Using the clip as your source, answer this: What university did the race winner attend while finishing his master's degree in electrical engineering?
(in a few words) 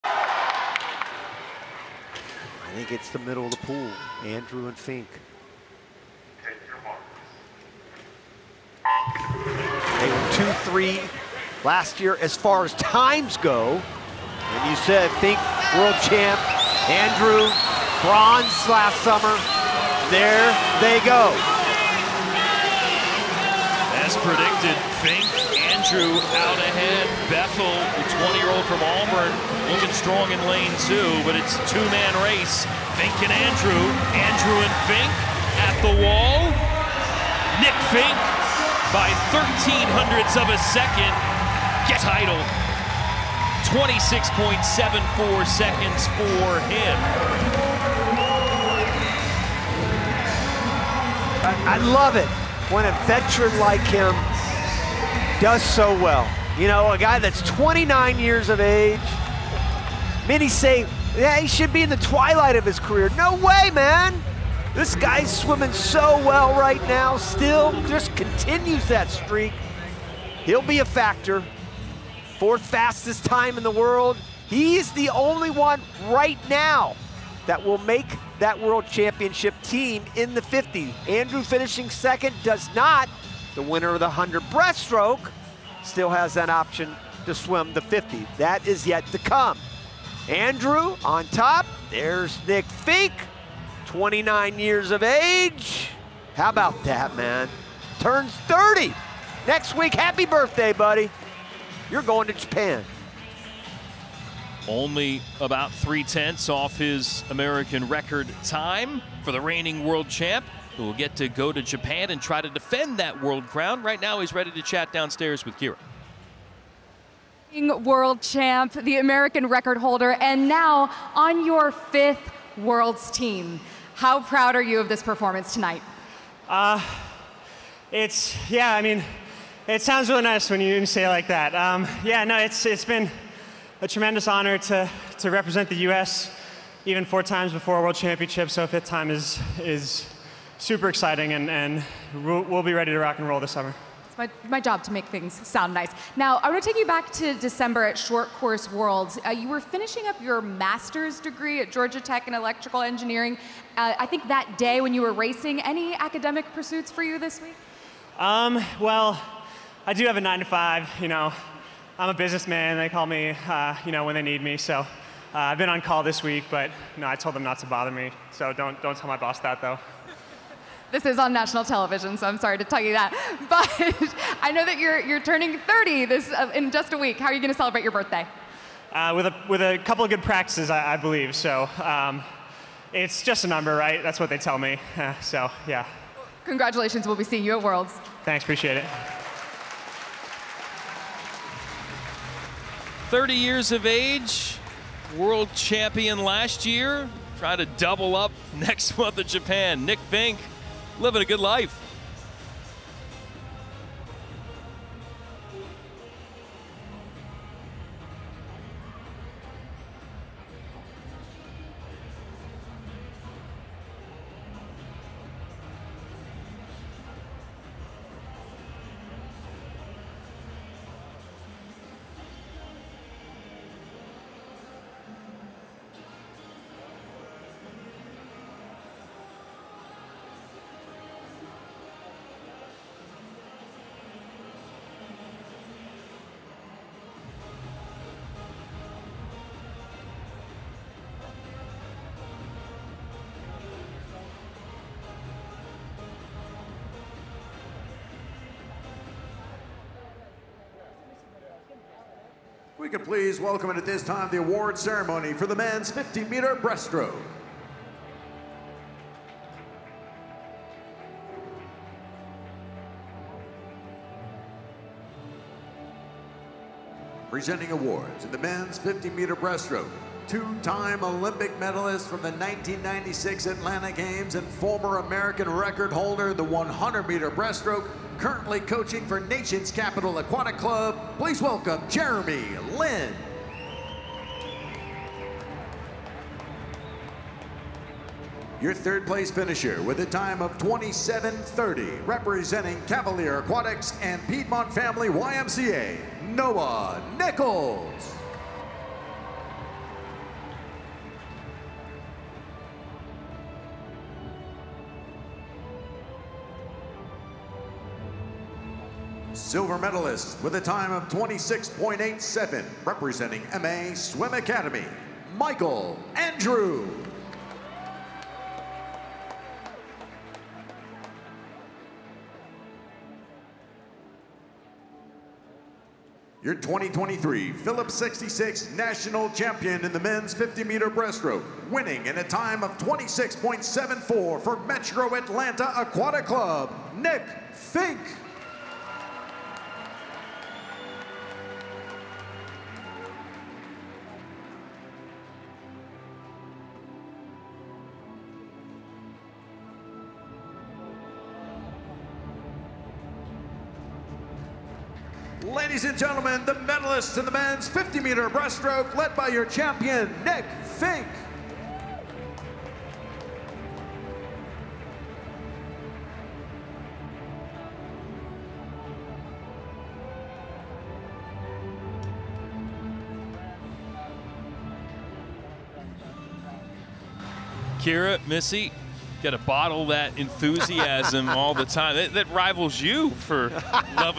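Georgia Tech.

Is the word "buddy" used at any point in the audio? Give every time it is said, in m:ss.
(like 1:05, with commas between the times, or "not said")
1:40.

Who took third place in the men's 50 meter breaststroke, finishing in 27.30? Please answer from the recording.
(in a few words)
Noah Nichols.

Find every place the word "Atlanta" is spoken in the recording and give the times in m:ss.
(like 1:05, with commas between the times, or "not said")
4:33, 5:35.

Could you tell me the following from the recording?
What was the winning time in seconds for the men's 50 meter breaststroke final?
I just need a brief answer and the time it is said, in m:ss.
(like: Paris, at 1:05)
26.74, at 0:43.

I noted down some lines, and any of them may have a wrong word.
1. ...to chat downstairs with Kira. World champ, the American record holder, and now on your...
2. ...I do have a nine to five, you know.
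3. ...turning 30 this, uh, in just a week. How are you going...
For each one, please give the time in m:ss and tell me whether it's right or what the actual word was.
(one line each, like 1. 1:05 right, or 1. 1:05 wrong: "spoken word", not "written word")
1. 1:54 right
2. 2:39 right
3. 2:55 right.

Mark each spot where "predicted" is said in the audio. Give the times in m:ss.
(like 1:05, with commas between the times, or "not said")
0:24.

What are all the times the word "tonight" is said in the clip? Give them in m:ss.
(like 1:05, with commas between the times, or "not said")
2:05.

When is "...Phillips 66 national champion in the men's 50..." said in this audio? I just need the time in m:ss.
5:27.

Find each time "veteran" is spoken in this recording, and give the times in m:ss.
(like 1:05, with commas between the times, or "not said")
0:53.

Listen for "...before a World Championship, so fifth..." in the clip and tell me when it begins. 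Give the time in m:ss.
2:17.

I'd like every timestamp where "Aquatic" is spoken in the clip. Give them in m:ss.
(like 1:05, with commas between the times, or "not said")
4:40, 4:53, 5:35.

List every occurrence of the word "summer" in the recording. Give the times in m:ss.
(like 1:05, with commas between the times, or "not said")
0:19, 2:23.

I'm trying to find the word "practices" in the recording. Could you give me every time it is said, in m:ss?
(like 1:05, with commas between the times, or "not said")
3:00.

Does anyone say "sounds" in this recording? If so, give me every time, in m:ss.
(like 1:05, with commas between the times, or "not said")
2:09, 2:25.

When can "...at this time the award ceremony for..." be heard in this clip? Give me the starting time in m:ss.
4:13.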